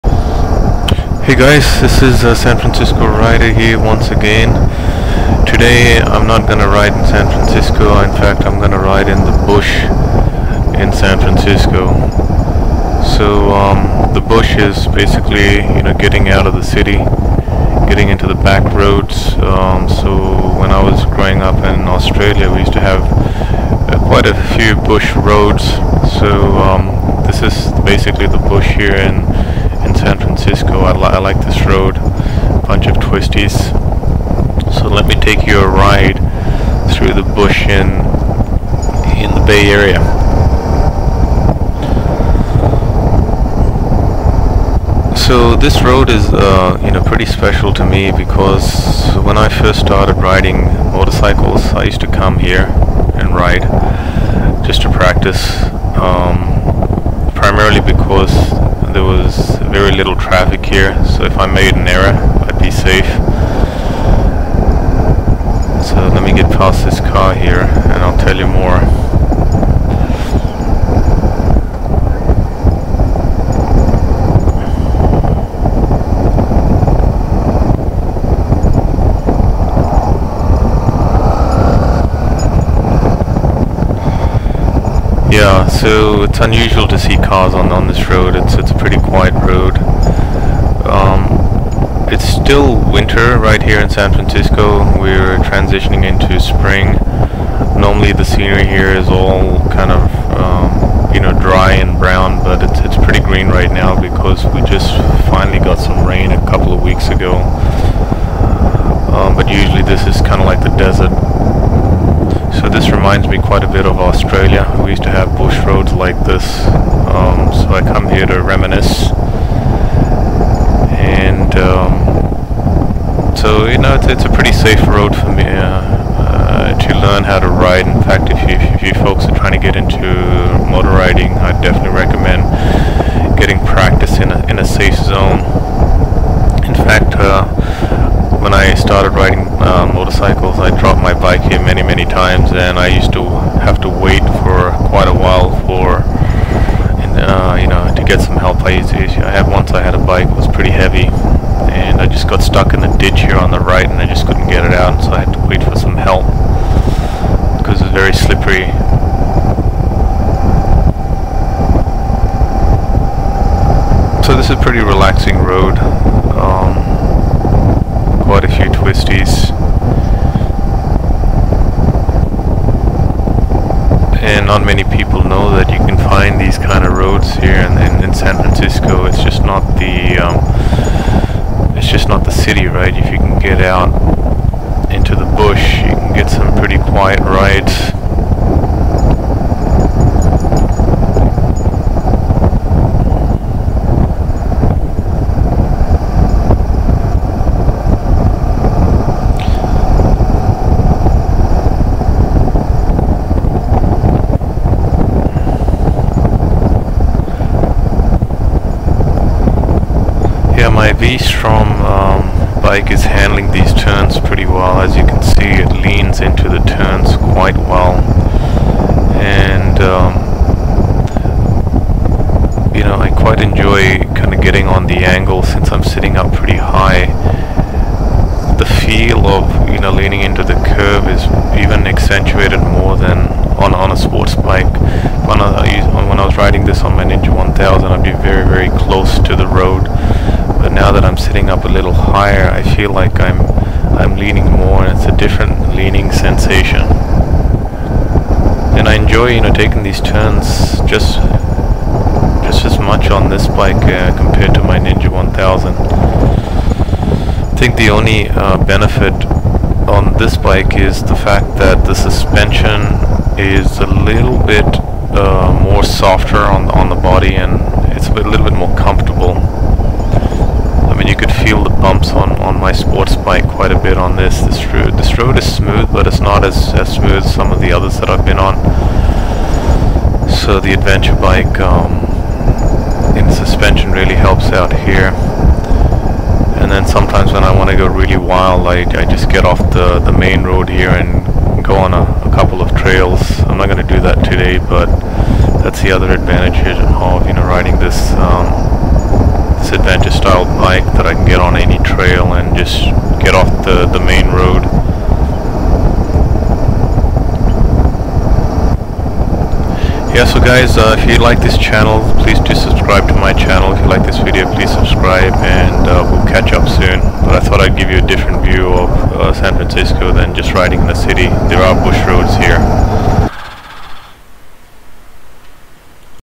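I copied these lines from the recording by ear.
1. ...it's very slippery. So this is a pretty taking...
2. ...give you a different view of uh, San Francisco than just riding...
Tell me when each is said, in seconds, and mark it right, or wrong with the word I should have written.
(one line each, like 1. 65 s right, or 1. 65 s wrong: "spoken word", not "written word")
1. 157 s wrong: "relaxing", not "taking"
2. 317 s right.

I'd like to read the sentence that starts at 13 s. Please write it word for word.
So um, the bush is basically you know getting out of the city, getting into the back roads.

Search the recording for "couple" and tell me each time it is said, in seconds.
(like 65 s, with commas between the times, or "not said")
106 s, 292 s.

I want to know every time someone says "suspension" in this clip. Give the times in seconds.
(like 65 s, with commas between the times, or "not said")
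261 s, 283 s.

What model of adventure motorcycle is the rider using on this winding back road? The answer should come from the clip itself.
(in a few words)
V-Strom.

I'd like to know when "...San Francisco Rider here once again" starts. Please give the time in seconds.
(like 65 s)
2 s.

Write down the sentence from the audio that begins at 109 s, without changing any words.
Um, but usually this is kind of like the desert reminds me quite a bit of Australia.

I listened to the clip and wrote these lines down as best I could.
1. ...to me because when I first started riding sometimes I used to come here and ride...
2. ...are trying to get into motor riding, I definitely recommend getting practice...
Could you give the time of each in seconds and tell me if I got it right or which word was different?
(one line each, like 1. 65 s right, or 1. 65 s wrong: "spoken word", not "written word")
1. 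47 s wrong: "motorcycles", not "sometimes"
2. 129 s right.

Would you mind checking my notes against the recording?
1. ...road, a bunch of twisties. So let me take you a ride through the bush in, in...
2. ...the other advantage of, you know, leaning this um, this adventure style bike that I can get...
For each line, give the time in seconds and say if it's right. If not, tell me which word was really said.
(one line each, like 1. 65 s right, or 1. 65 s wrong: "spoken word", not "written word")
1. 31 s right
2. 295 s wrong: "riding", not "leaning".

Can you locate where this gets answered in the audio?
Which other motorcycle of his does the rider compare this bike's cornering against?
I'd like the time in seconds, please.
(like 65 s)
254 s.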